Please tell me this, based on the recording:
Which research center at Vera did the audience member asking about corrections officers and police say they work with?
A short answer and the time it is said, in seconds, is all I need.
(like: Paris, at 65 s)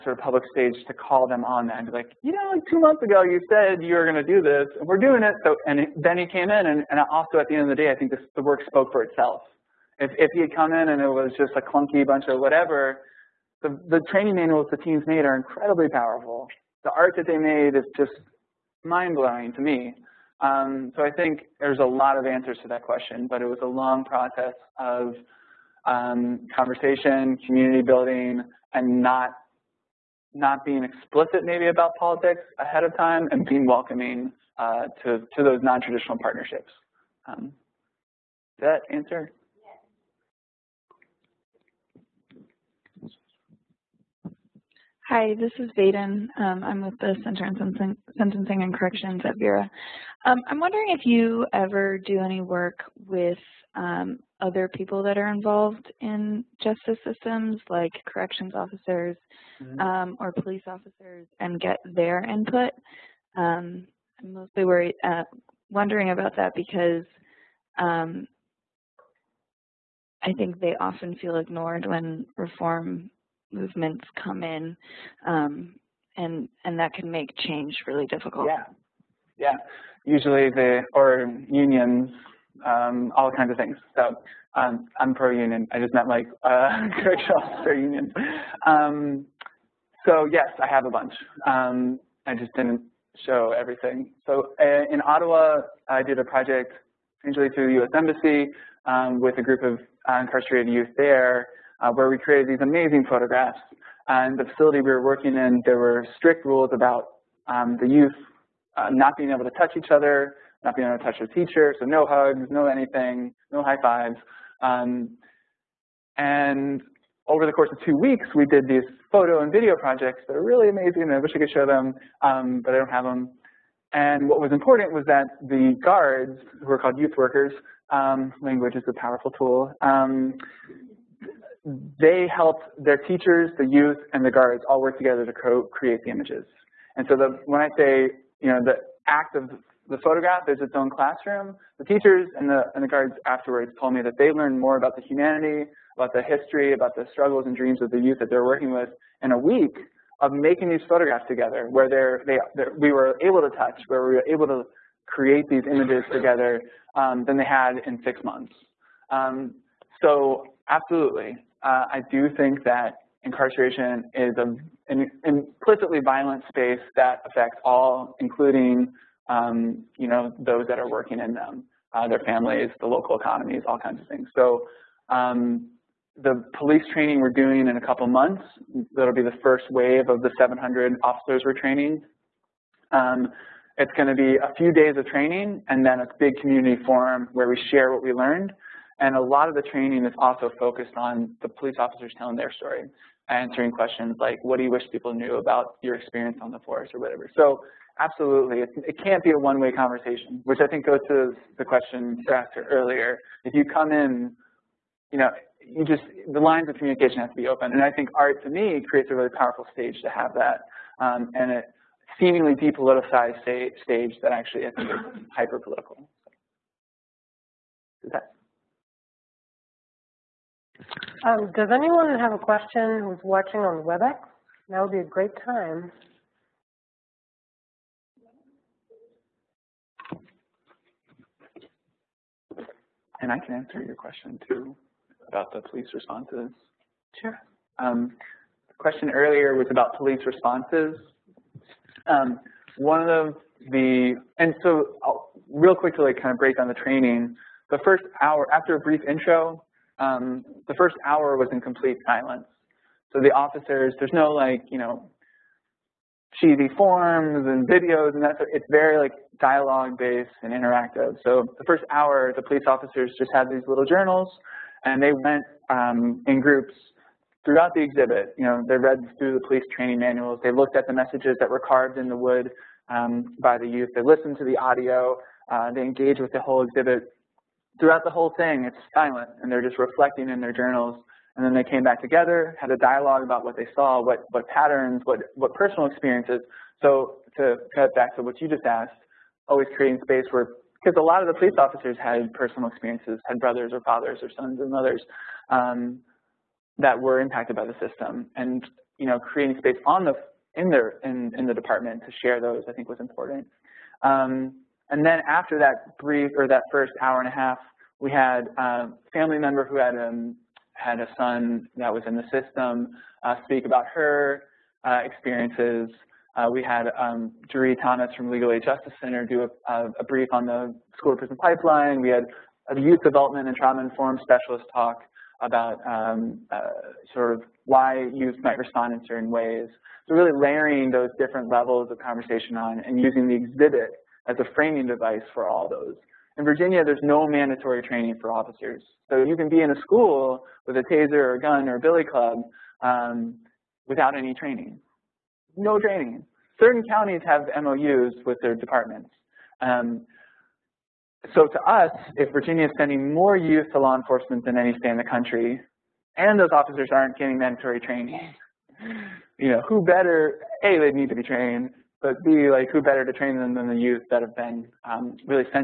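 Center on Sentencing and Corrections, at 47 s.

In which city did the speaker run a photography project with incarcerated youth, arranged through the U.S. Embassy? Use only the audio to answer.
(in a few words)
Ottawa.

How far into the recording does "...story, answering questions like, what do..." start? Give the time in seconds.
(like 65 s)
192 s.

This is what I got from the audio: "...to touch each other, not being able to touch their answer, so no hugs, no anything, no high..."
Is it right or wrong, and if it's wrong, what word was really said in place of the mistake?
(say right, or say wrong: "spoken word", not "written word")
wrong: "teacher", not "answer".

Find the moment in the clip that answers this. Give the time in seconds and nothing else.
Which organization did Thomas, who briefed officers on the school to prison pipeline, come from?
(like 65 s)
318 s.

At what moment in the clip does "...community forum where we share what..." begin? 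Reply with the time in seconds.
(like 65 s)
186 s.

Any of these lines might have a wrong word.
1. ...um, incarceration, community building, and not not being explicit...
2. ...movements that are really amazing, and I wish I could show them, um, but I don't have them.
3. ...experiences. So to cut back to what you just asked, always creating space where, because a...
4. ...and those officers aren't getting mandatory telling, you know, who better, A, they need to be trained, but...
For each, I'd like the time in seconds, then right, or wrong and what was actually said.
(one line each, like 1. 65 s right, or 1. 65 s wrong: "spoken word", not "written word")
1. 25 s wrong: "conversation", not "incarceration"
2. 119 s wrong: "projects", not "movements"
3. 285 s right
4. 356 s wrong: "training", not "telling".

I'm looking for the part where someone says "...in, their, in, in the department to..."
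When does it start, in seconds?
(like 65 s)
300 s.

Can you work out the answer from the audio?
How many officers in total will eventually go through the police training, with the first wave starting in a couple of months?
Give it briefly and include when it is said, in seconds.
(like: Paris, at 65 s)
700, at 180 s.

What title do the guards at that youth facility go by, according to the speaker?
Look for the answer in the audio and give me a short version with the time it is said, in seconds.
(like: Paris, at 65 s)
youth workers, at 126 s.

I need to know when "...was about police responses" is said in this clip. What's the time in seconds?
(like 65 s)
239 s.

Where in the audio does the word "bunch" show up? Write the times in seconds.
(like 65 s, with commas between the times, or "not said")
12 s, 90 s.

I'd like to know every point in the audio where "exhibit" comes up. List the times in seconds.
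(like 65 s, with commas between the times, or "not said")
267 s, 276 s, 333 s.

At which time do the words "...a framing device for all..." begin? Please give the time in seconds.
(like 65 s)
334 s.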